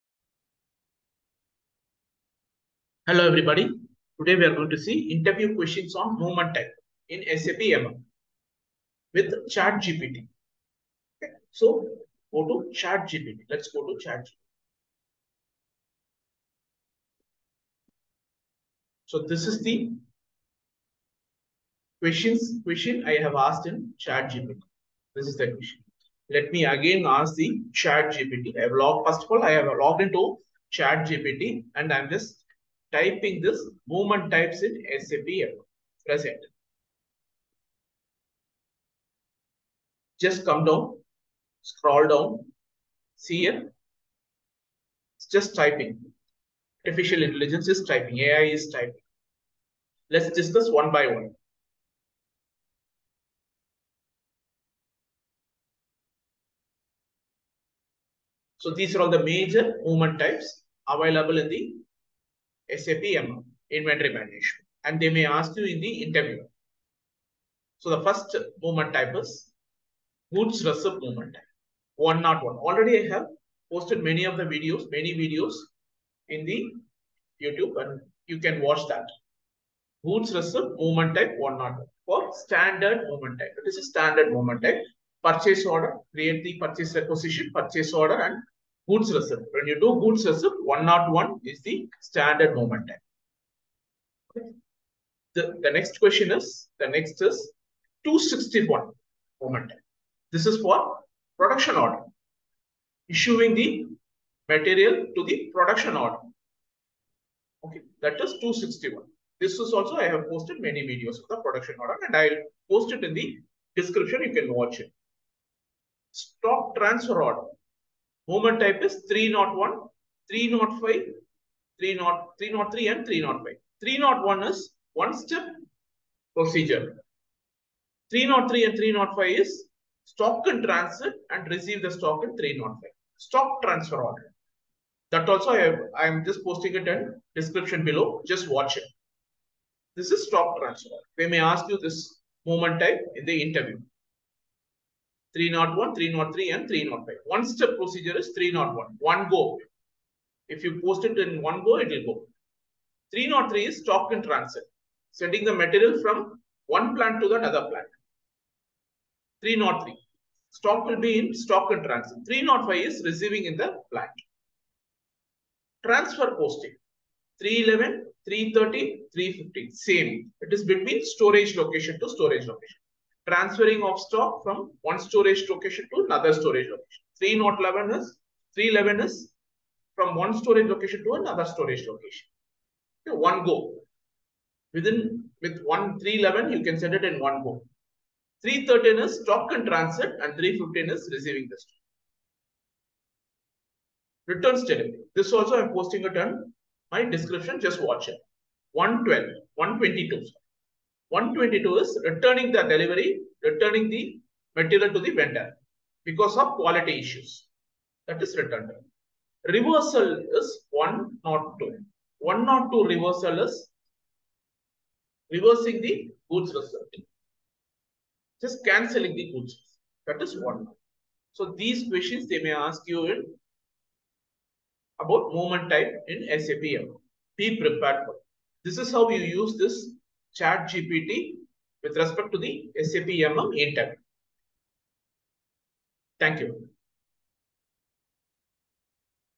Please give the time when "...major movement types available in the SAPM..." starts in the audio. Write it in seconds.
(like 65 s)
59 s.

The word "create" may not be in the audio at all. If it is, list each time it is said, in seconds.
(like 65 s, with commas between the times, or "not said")
86 s.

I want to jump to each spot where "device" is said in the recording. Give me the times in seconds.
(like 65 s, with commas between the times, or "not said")
not said.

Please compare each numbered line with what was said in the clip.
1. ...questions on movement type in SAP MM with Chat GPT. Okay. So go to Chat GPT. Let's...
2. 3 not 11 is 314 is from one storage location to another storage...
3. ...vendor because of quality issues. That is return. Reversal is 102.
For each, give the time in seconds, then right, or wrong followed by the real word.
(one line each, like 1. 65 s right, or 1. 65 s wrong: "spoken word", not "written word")
1. 5 s right
2. 177 s wrong: "311", not "314"
3. 205 s right.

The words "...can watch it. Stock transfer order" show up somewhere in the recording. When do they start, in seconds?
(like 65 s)
114 s.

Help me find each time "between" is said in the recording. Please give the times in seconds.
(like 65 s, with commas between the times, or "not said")
170 s.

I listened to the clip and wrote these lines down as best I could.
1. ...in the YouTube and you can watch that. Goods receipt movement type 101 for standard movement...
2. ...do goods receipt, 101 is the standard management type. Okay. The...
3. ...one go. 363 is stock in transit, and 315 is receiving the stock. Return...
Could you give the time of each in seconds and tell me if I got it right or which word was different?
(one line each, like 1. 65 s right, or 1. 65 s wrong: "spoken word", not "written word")
1. 76 s right
2. 89 s wrong: "movement", not "management"
3. 187 s wrong: "313", not "363".